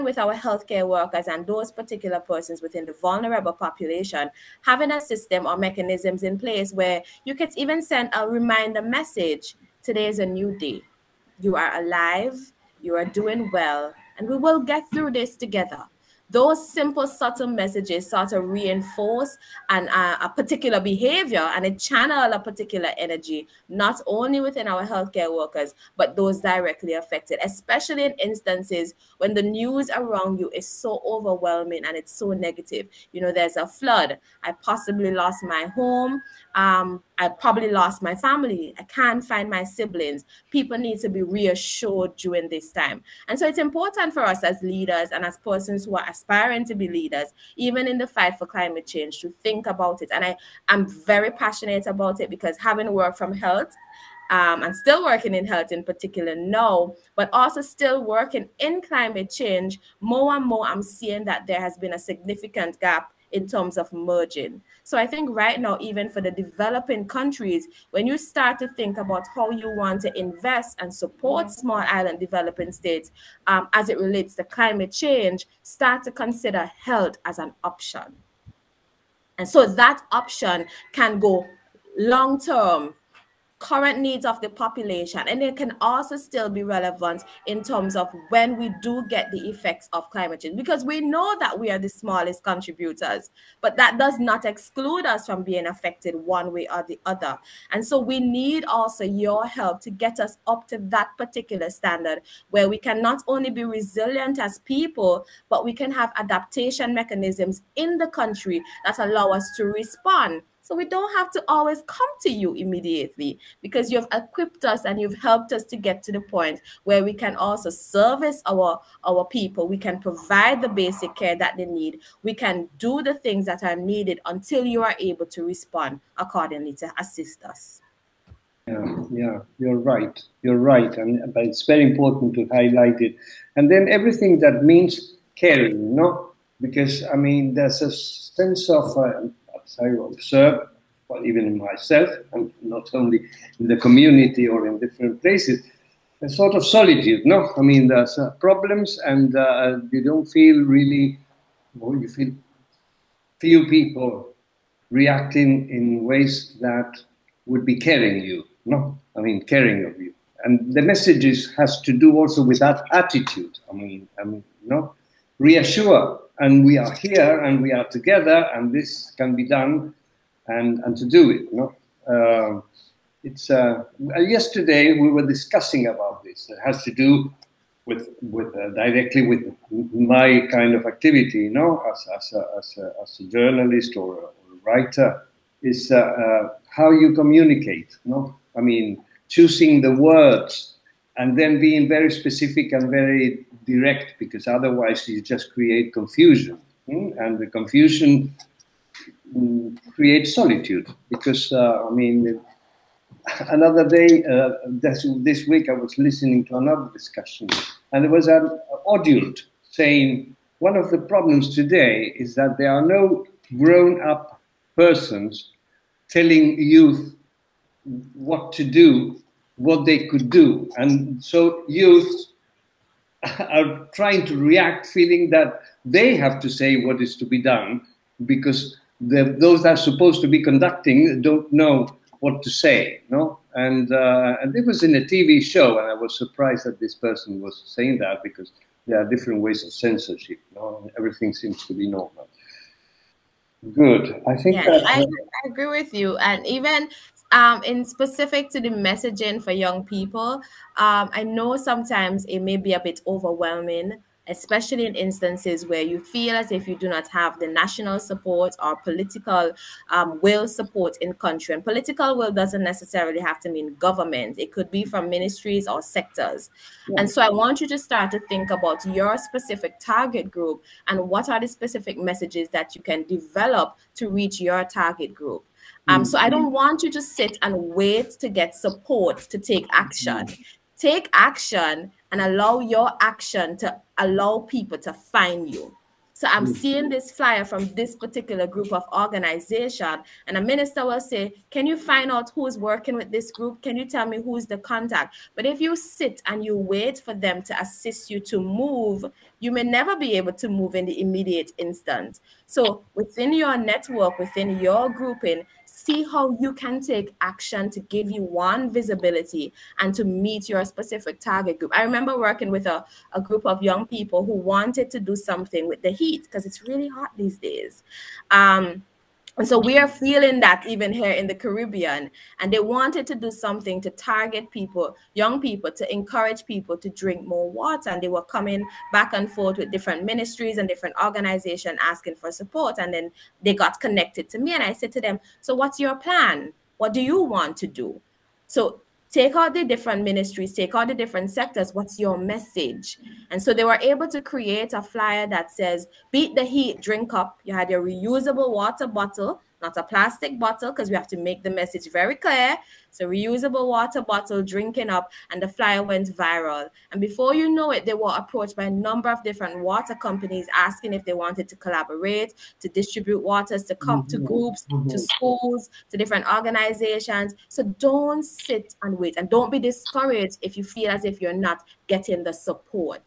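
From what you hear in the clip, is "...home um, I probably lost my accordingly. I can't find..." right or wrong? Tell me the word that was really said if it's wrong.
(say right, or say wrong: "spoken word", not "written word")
wrong: "family", not "accordingly".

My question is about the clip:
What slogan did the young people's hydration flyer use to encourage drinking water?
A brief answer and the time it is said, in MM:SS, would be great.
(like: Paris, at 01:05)
Beat the heat, drink up, at 05:46.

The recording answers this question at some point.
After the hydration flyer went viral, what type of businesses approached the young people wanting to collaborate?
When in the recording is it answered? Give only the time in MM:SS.
05:59.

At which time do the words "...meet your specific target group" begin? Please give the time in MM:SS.
05:10.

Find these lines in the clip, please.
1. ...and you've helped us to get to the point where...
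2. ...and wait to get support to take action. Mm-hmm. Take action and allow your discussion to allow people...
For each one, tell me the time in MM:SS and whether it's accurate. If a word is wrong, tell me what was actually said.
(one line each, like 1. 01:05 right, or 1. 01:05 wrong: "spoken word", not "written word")
1. 01:54 right
2. 04:37 wrong: "action", not "discussion".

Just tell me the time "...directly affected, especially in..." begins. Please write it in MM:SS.
00:26.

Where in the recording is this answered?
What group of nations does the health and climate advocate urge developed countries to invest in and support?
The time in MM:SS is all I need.
01:11.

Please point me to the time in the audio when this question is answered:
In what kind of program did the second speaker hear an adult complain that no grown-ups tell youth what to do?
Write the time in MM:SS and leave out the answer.
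03:55.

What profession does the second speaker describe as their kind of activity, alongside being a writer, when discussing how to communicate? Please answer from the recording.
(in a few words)
journalist.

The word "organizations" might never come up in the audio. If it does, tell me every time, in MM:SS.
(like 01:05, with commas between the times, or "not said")
04:48, 05:31, 06:06.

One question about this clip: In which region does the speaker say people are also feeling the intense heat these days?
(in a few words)
the Caribbean.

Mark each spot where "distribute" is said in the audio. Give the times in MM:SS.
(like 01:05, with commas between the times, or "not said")
06:02.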